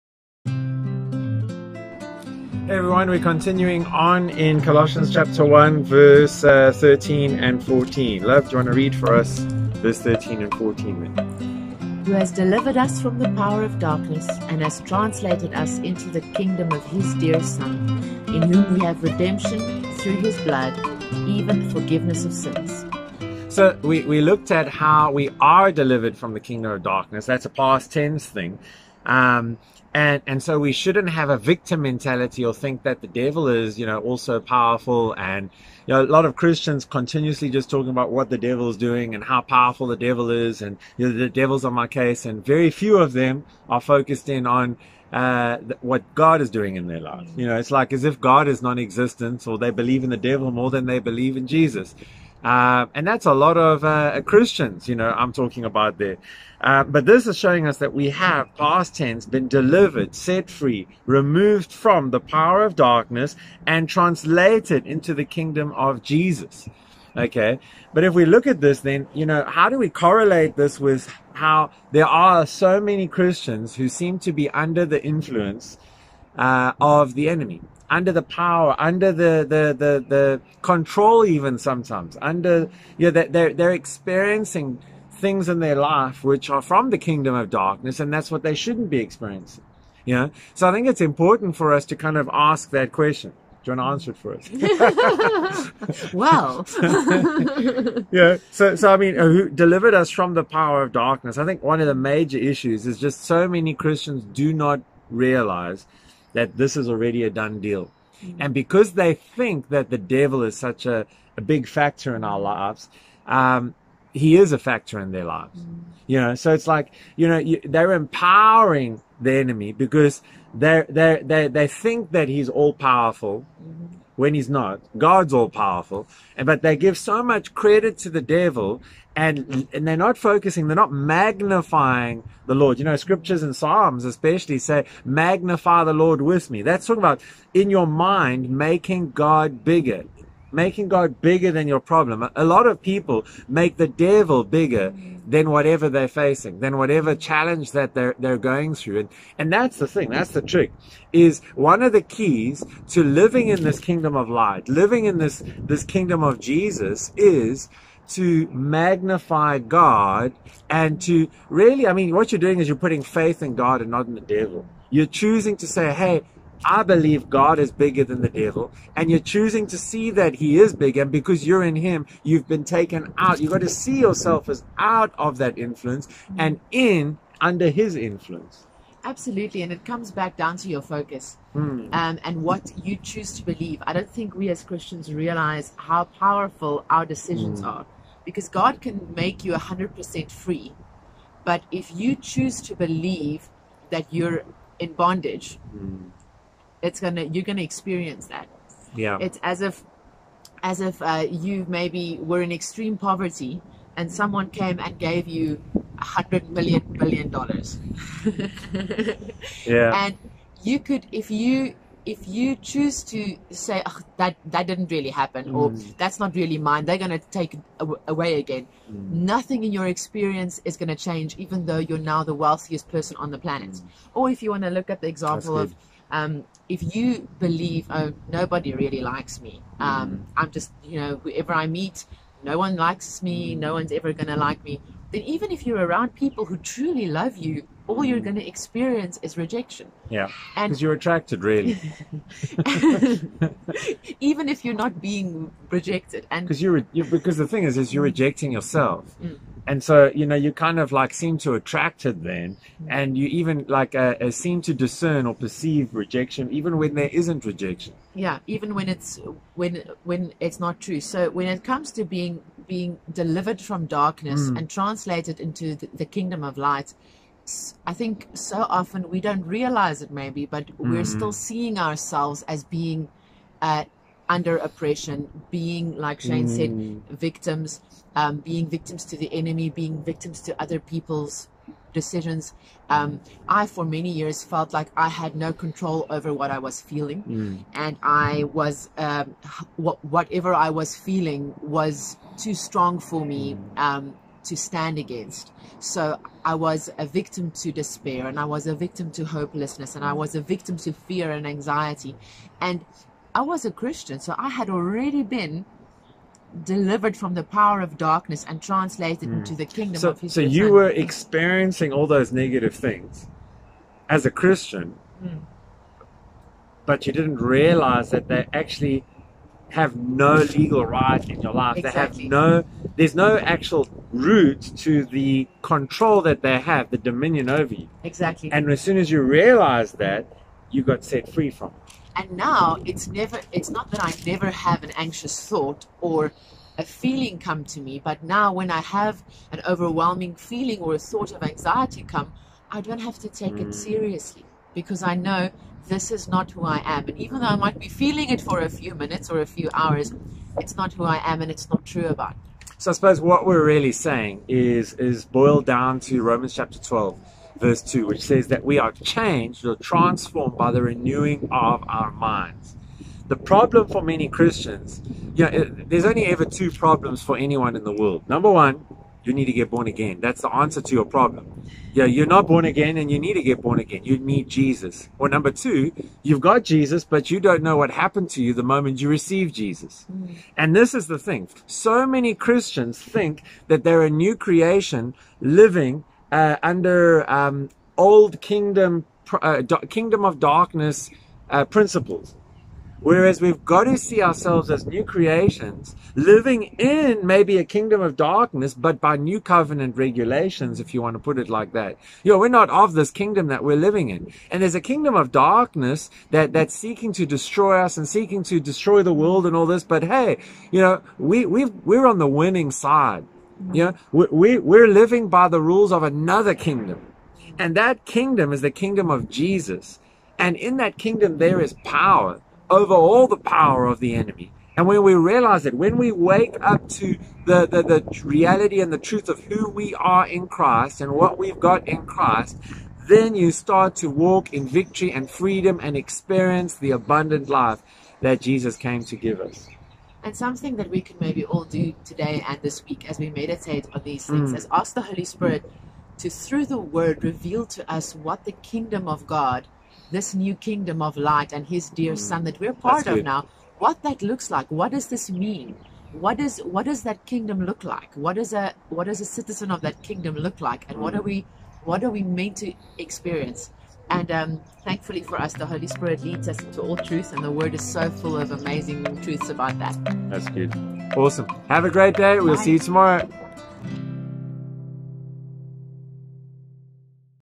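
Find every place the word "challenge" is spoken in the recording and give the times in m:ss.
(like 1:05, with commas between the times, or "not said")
2:27.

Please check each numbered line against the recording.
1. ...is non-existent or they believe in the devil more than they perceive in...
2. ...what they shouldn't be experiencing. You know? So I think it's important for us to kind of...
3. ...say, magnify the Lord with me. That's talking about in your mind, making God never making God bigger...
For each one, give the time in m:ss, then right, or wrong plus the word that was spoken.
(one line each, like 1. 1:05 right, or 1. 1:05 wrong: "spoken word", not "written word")
1. 0:48 wrong: "believe", not "perceive"
2. 1:28 right
3. 2:14 wrong: "bigger", not "never".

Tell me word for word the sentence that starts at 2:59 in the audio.
Absolutely, and it comes back down to your focus mm.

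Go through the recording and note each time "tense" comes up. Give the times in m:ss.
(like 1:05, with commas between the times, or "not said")
0:27, 0:58.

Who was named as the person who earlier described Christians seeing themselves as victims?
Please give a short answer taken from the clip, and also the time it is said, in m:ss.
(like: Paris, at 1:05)
Shane, at 4:36.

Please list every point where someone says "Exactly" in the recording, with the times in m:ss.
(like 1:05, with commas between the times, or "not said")
5:21, 5:28.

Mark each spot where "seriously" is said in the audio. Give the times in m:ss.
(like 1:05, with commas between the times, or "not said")
5:43.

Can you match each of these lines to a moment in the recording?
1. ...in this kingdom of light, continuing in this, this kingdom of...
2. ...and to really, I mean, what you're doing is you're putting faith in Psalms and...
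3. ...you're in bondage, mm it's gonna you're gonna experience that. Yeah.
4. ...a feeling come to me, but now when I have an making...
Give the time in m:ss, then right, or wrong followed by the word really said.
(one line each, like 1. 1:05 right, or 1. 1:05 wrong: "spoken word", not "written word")
1. 2:33 wrong: "living", not "continuing"
2. 2:40 wrong: "God", not "Psalms"
3. 3:14 right
4. 5:36 wrong: "overwhelming", not "making".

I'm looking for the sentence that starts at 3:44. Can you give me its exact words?
or if you want to look at the example of um, if you believe, oh, nobody really likes me, mm.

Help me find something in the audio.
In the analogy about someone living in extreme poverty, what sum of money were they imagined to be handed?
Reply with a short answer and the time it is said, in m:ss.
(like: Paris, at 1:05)
a hundred million billion dollars, at 3:25.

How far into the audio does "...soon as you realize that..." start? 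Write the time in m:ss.
5:28.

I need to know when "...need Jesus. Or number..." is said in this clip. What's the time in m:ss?
6:14.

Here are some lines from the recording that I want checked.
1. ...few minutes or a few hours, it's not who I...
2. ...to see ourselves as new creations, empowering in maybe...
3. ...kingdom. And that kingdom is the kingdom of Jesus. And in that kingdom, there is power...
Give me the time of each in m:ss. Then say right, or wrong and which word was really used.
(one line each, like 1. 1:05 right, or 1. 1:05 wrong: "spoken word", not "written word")
1. 5:48 right
2. 6:33 wrong: "living", not "empowering"
3. 6:56 right.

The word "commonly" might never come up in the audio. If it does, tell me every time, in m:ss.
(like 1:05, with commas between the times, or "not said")
not said.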